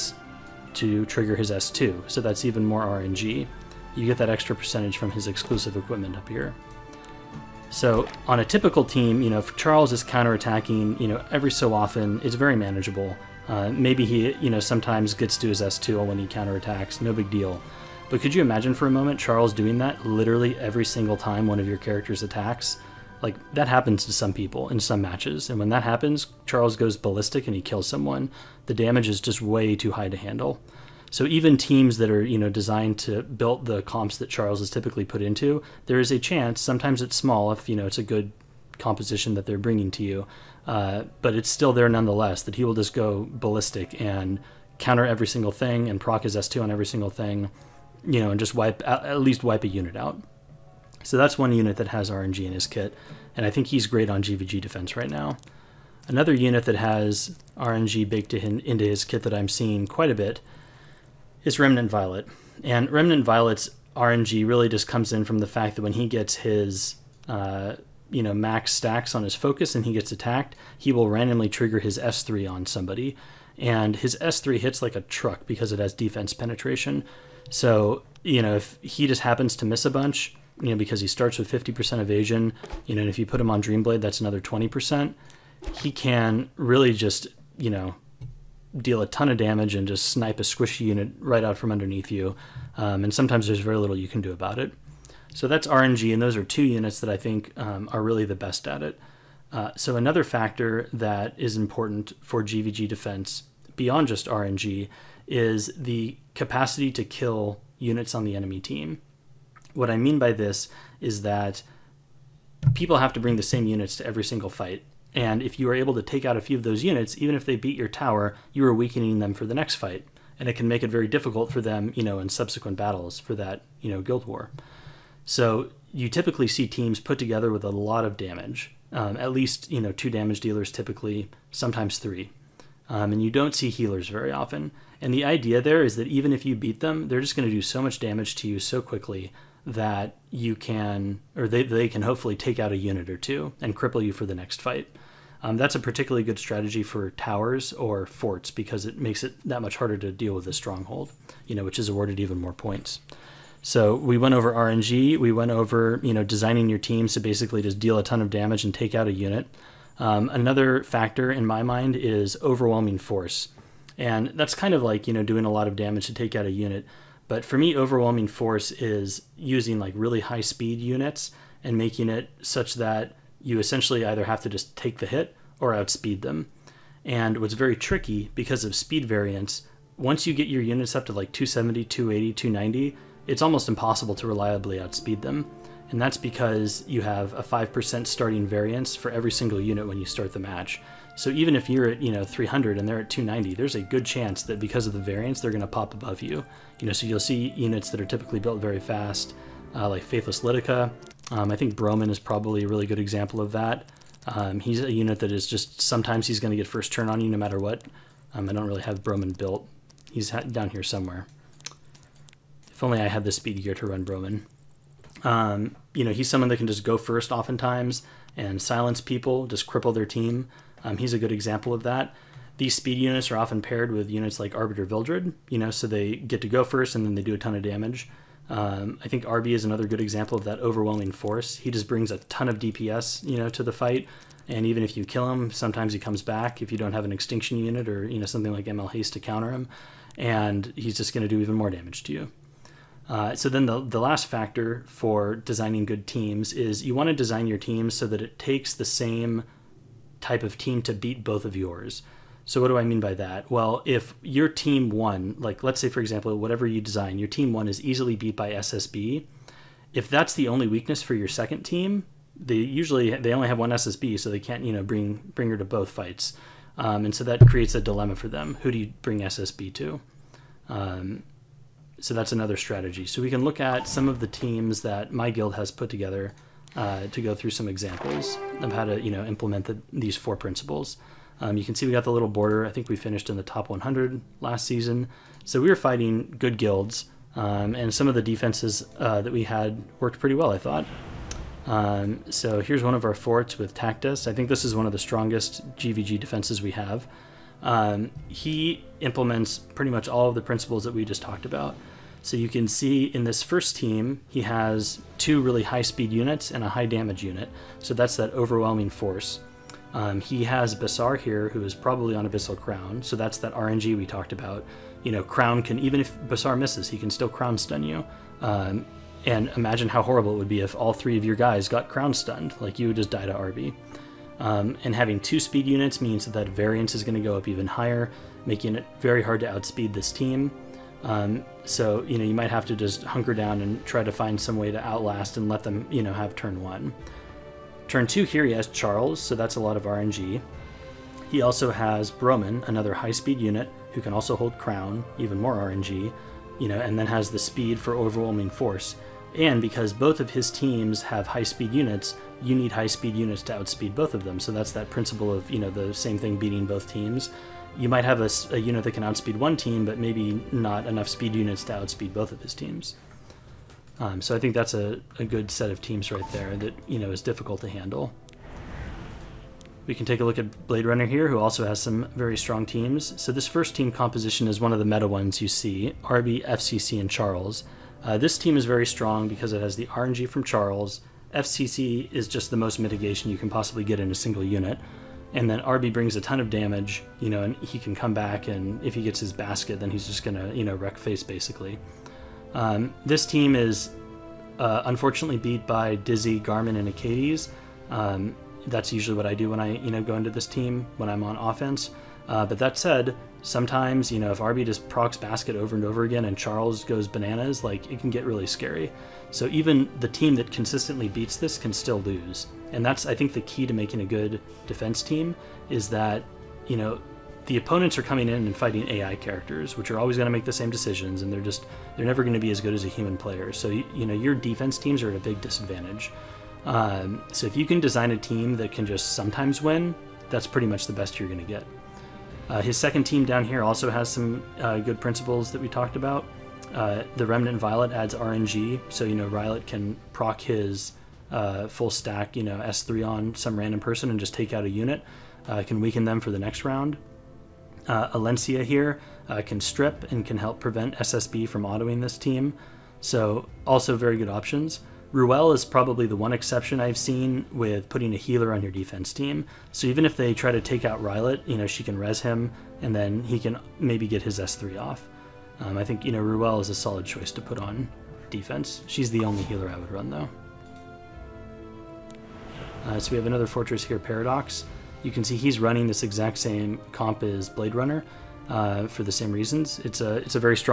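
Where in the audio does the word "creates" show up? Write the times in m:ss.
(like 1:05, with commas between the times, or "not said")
4:27.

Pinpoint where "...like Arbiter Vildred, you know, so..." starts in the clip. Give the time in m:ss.
3:44.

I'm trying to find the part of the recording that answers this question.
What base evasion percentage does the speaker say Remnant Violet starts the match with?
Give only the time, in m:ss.
1:21.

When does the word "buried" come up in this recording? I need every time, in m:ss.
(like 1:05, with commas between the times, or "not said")
not said.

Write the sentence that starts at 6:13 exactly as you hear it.
So this first team composition is one of the meta ones you see, RB, FCC, and Charles.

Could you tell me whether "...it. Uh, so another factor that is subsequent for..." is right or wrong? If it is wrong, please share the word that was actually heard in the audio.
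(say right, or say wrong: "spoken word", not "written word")
wrong: "important", not "subsequent".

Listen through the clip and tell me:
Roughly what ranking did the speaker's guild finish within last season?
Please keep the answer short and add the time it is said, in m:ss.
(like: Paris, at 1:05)
top 100, at 4:43.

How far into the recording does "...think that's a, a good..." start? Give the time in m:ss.
6:04.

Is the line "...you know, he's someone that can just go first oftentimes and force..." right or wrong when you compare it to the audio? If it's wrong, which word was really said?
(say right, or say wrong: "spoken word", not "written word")
wrong: "silence", not "force".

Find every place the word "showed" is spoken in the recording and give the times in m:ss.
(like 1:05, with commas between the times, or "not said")
not said.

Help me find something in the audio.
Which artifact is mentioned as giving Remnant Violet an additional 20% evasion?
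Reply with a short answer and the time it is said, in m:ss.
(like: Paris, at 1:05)
Dreamblade, at 1:23.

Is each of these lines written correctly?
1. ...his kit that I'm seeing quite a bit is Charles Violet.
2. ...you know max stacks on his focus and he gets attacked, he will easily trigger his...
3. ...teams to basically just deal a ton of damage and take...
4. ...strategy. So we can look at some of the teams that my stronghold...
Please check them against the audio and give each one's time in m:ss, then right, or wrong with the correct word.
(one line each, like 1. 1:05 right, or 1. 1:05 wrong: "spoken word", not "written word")
1. 0:58 wrong: "Remnant", not "Charles"
2. 1:08 wrong: "randomly", not "easily"
3. 2:36 right
4. 4:32 wrong: "guild", not "stronghold".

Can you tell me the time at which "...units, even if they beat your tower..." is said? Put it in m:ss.
1:56.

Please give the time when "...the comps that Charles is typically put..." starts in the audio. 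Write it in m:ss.
0:33.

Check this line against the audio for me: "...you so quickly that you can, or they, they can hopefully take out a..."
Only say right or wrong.
right.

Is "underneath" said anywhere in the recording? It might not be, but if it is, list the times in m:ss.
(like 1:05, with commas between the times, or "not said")
1:31.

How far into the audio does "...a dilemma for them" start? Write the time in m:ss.
4:27.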